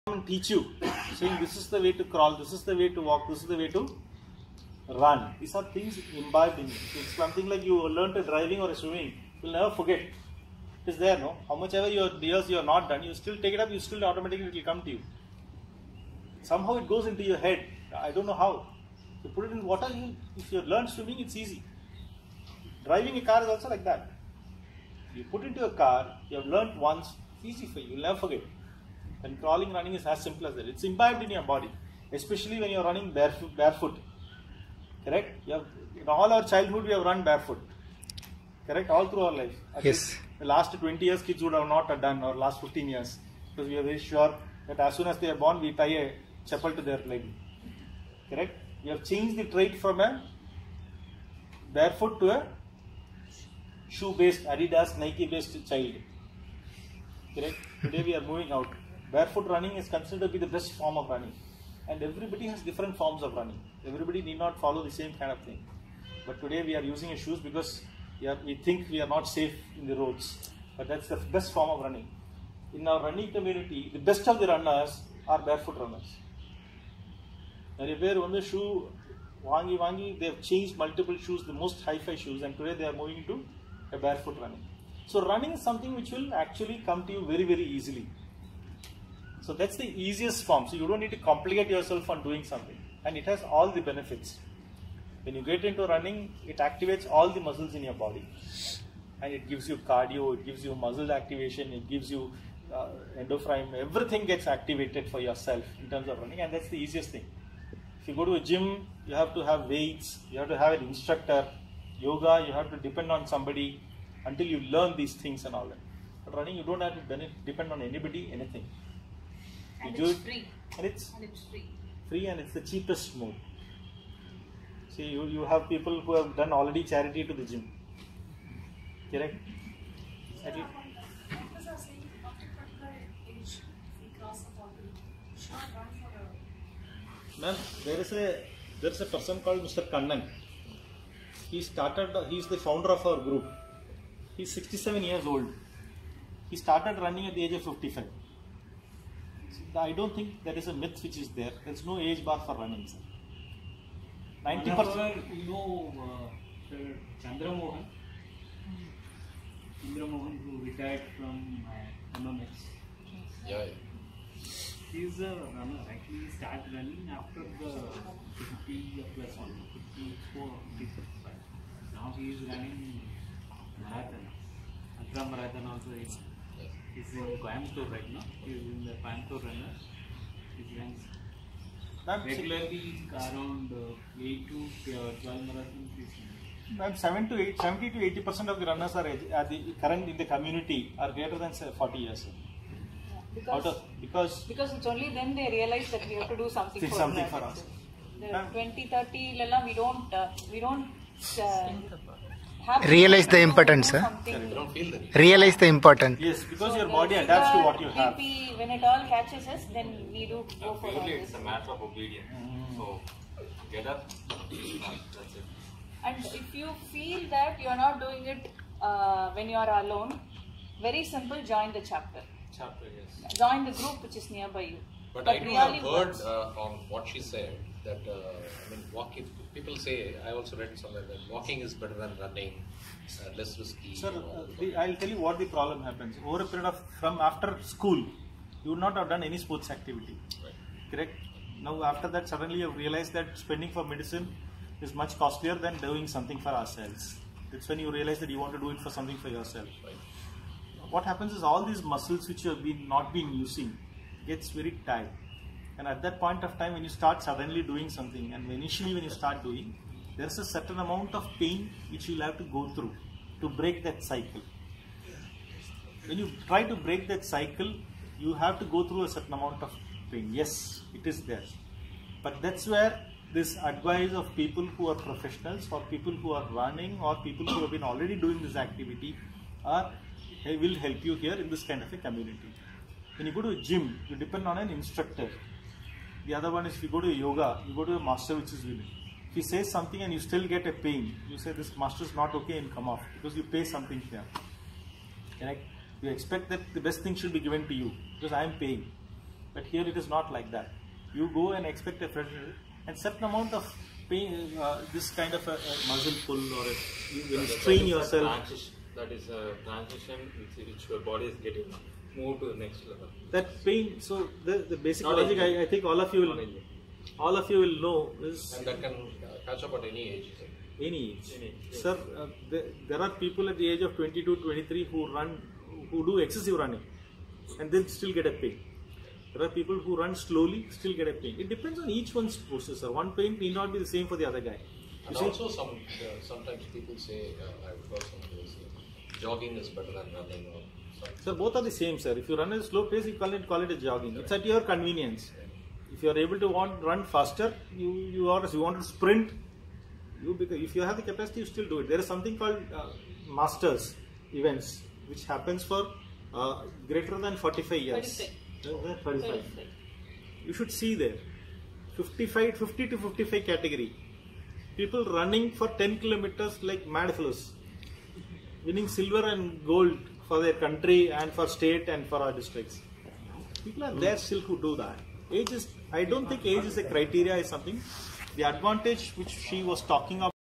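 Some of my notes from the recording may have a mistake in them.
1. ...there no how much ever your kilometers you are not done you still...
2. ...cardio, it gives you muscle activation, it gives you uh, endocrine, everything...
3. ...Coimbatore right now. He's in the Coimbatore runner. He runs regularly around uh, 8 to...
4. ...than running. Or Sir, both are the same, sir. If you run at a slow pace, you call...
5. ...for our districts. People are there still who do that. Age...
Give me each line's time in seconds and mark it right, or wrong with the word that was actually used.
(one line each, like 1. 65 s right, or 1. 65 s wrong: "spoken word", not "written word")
1. 11 s wrong: "years", not "kilometers"
2. 99 s right
3. 177 s right
4. 339 s right
5. 372 s right.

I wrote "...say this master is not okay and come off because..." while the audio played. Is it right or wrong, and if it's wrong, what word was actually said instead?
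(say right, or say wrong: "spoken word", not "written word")
right.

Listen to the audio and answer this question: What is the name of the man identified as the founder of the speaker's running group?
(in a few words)
Mr. Kannan.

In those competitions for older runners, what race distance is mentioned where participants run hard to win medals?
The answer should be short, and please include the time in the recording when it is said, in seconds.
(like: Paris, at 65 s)
10 kilometers, at 365 s.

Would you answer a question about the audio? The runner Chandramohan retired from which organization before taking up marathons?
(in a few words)
MMX.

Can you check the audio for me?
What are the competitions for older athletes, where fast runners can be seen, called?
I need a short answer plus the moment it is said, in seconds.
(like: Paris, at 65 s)
Masters events, at 353 s.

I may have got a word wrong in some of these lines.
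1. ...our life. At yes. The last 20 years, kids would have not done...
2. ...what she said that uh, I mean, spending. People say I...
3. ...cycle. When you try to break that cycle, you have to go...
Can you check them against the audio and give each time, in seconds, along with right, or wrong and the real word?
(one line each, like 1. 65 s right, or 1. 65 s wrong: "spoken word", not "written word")
1. 39 s right
2. 226 s wrong: "walking", not "spending"
3. 264 s right.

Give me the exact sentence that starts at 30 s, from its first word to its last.
It's imbibed in your body, especially when you're running barefoot.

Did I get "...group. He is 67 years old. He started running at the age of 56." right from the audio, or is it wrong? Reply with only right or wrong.
wrong.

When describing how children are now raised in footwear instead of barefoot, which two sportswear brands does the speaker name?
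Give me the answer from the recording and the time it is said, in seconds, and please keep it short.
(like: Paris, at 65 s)
Adidas, Nike, at 54 s.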